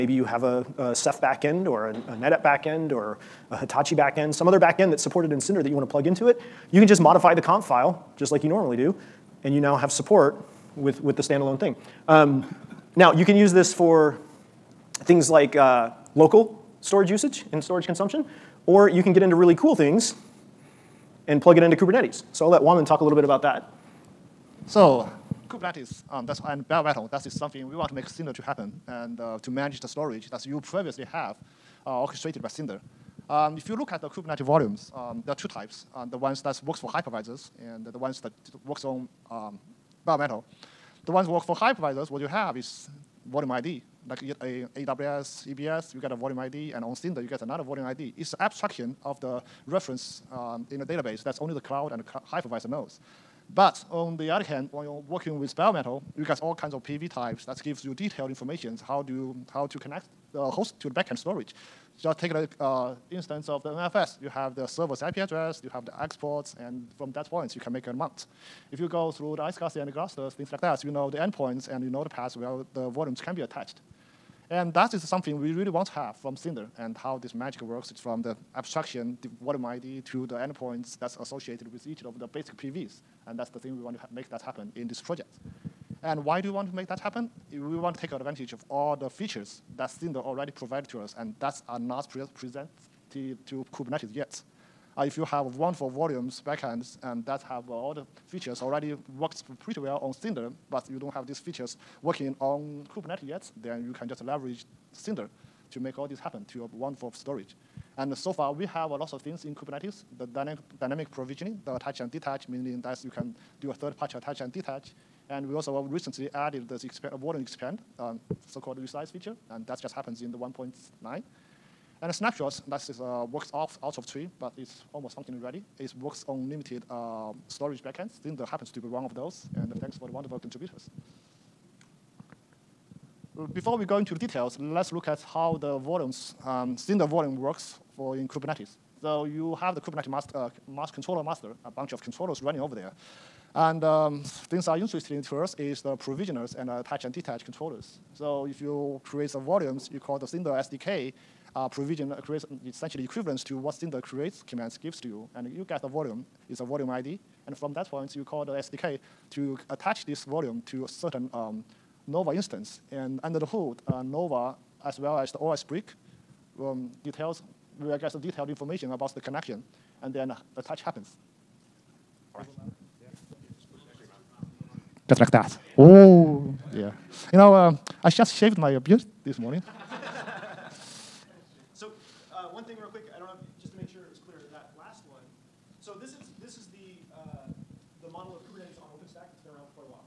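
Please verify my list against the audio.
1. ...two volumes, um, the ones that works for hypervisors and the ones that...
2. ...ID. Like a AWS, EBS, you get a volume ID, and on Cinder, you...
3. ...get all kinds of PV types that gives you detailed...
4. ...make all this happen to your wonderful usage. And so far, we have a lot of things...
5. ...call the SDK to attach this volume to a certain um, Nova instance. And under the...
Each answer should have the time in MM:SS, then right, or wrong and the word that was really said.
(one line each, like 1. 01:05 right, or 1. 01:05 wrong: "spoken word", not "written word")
1. 00:35 wrong: "types", not "volumes"
2. 00:43 right
3. 00:56 right
4. 01:45 wrong: "storage", not "usage"
5. 02:38 right.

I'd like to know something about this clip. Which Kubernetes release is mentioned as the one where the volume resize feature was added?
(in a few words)
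1.9.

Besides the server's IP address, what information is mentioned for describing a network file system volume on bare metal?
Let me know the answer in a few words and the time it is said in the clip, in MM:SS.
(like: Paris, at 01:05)
The exports, at 01:05.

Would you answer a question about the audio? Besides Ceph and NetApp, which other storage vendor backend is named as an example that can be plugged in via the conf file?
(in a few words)
Hitachi.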